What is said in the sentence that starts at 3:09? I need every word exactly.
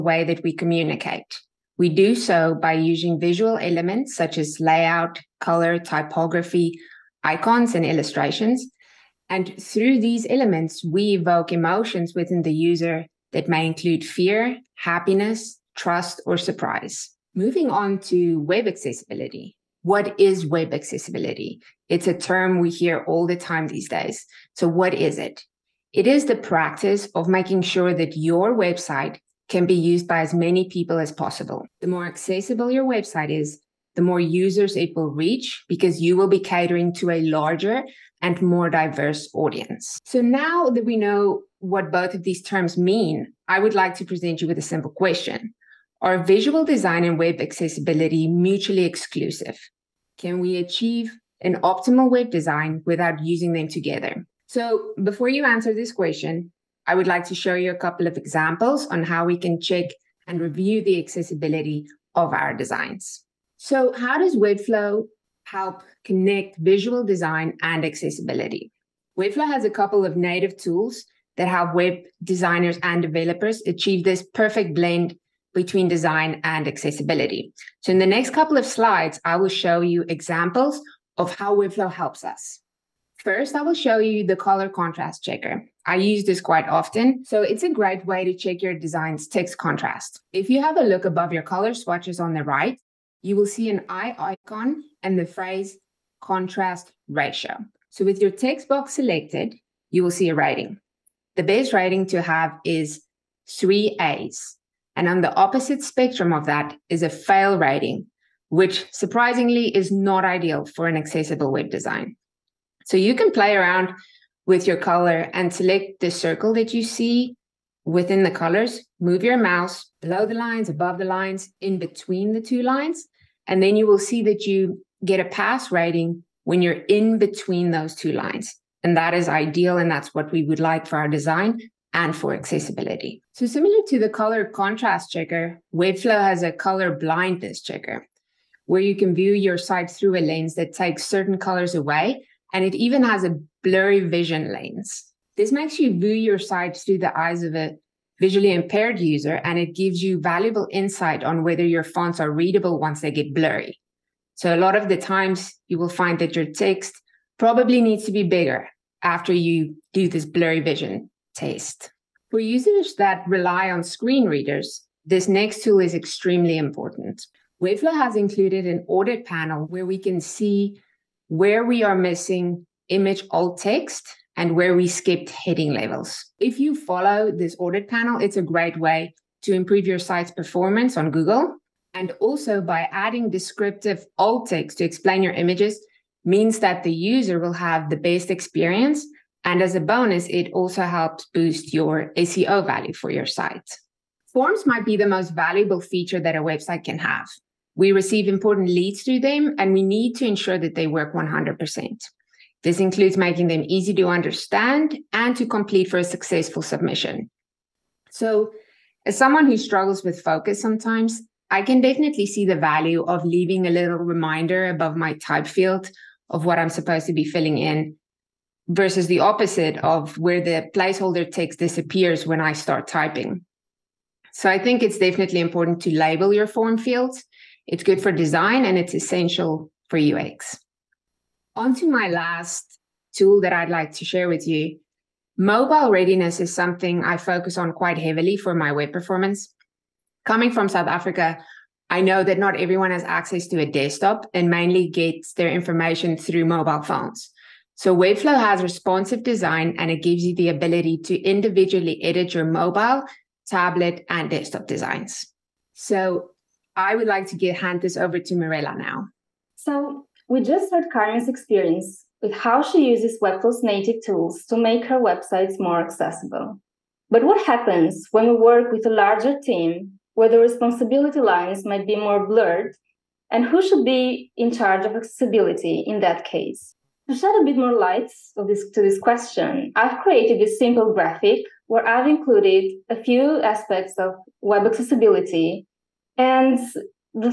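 And as a bonus, it also helps boost your SEO value for your site.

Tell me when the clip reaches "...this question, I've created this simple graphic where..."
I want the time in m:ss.
4:38.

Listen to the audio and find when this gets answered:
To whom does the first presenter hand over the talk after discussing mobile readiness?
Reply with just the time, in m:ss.
4:18.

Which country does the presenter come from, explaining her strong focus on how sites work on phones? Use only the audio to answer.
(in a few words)
South Africa.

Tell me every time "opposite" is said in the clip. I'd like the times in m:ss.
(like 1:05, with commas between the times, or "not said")
1:45, 3:39.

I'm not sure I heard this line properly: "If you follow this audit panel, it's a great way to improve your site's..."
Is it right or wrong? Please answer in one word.
right.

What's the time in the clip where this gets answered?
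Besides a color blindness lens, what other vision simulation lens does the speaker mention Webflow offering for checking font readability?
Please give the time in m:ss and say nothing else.
2:23.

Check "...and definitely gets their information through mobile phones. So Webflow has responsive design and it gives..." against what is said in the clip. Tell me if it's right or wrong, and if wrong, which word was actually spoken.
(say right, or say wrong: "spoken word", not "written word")
wrong: "mainly", not "definitely".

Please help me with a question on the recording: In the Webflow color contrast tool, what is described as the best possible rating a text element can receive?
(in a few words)
three A's.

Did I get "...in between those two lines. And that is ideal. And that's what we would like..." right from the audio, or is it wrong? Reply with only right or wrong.
right.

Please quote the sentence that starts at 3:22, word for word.
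This includes making them easy to understand and to complete for a successful submission.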